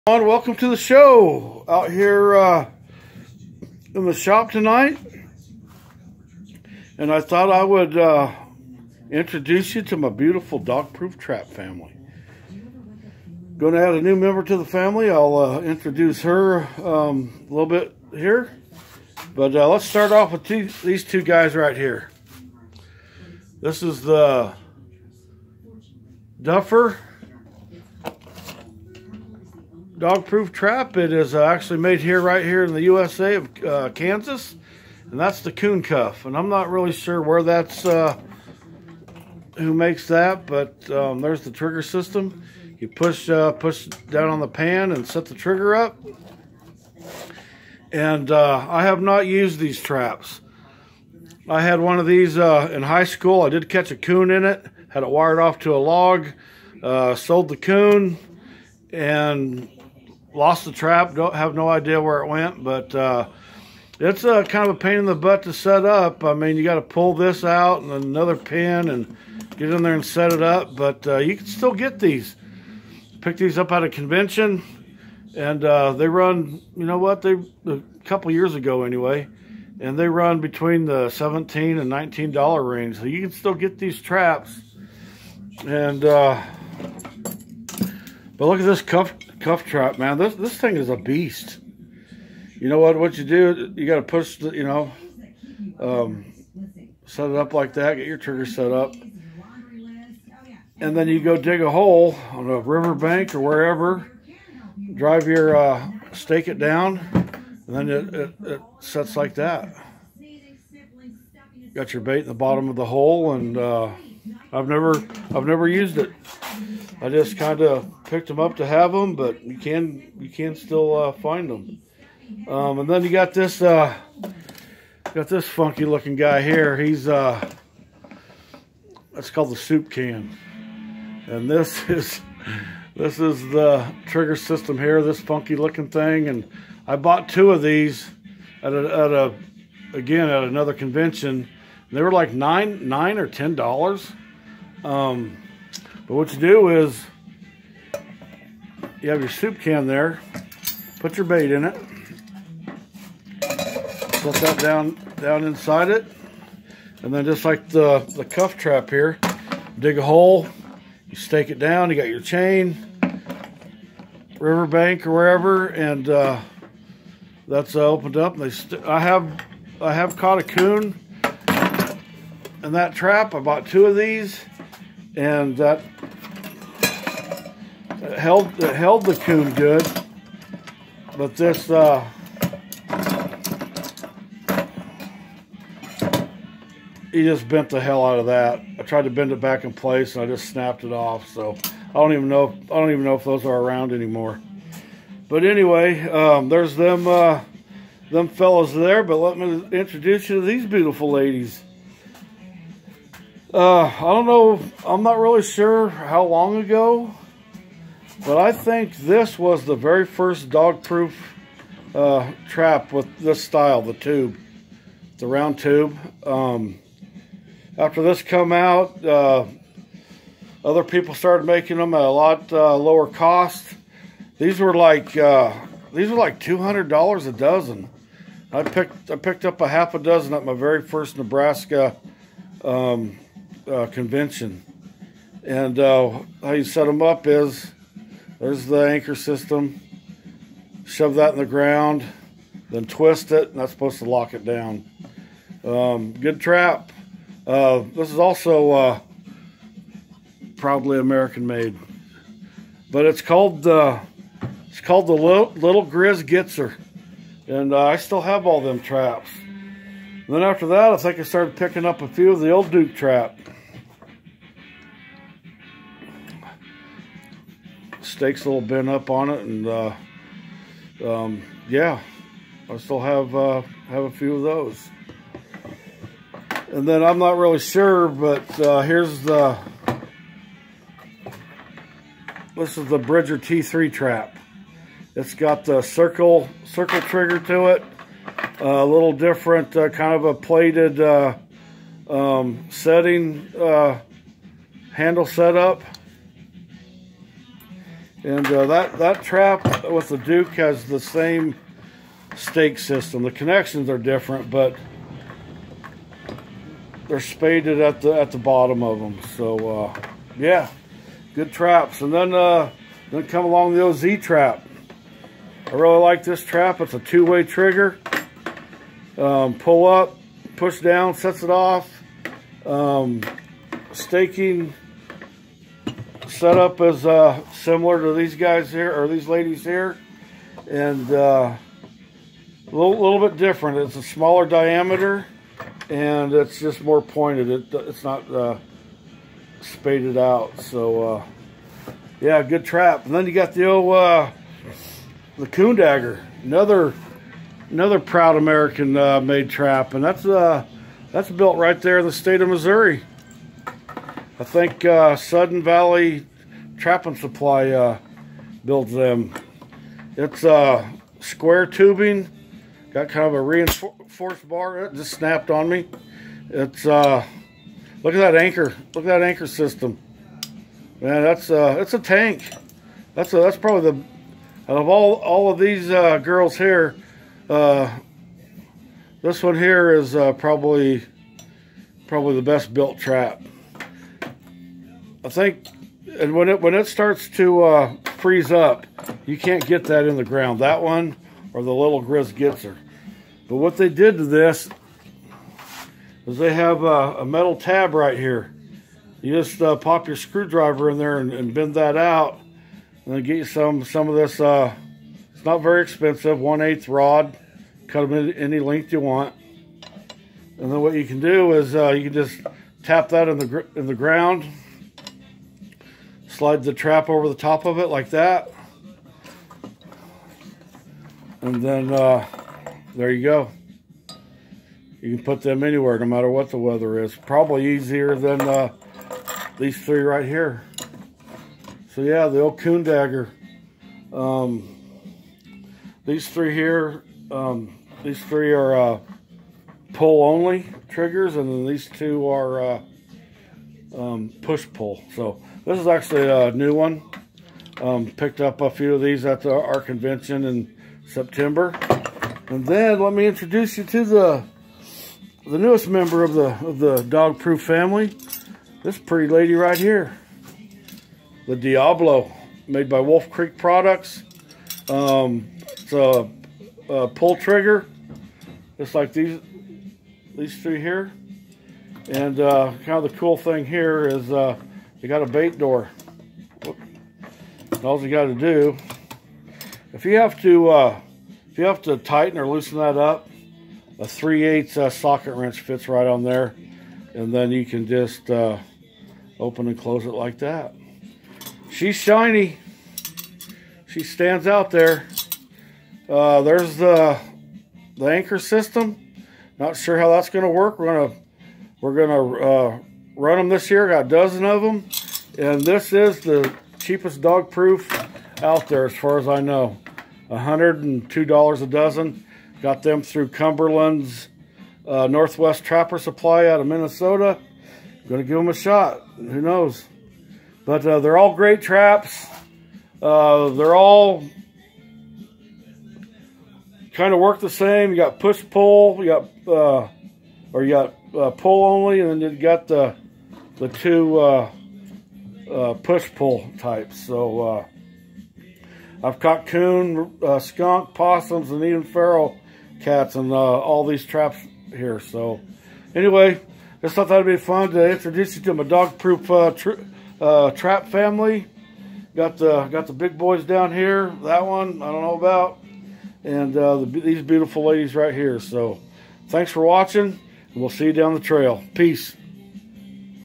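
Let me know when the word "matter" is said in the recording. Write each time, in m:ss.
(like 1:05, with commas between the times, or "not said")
7:06.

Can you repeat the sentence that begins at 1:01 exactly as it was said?
Don't have no idea where it went, but uh, it's a kind of a pain in the butt to set up.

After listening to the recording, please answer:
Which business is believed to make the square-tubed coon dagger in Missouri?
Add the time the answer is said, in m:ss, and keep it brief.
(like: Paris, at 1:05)
Sudden Valley Trapping Supply, at 5:55.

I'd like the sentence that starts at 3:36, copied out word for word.
Um, after this come out, uh, other people started making them at a lot uh, lower cost.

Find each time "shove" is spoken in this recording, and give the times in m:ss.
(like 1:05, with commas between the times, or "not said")
4:00.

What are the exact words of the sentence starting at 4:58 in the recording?
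And that, that trap with the Duke has the same stake system.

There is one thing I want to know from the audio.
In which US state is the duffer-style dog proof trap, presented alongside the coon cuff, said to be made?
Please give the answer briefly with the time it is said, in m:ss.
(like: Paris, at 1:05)
Kansas, at 0:33.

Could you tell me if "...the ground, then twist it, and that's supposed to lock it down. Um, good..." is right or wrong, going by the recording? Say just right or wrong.
right.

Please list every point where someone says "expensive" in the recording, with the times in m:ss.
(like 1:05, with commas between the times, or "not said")
6:45.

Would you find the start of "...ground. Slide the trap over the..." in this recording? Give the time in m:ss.
6:53.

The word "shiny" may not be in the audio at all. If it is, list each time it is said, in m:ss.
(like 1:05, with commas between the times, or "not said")
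8:11.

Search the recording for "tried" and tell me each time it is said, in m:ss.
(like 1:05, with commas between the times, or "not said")
3:08.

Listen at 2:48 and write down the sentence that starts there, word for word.
And they I have I have caught a coon in that trap.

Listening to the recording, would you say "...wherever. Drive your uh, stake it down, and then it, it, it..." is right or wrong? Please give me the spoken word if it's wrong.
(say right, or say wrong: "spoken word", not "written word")
right.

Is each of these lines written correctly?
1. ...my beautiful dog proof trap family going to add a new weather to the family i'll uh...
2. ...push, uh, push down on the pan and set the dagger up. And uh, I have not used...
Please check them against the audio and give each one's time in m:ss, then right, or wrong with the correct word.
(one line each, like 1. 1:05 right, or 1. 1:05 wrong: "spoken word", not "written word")
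1. 0:09 wrong: "member", not "weather"
2. 0:42 wrong: "trigger", not "dagger".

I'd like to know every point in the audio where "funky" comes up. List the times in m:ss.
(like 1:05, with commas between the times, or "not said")
2:05, 2:15.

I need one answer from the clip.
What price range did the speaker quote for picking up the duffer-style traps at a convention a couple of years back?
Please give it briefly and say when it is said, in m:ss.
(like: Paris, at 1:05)
$17 to $19, at 1:21.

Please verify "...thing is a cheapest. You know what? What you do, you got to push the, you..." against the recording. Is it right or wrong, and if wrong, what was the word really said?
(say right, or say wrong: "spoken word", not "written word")
wrong: "beast", not "cheapest".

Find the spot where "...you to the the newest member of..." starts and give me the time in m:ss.
7:33.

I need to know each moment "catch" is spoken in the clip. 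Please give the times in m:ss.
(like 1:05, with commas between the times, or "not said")
0:53.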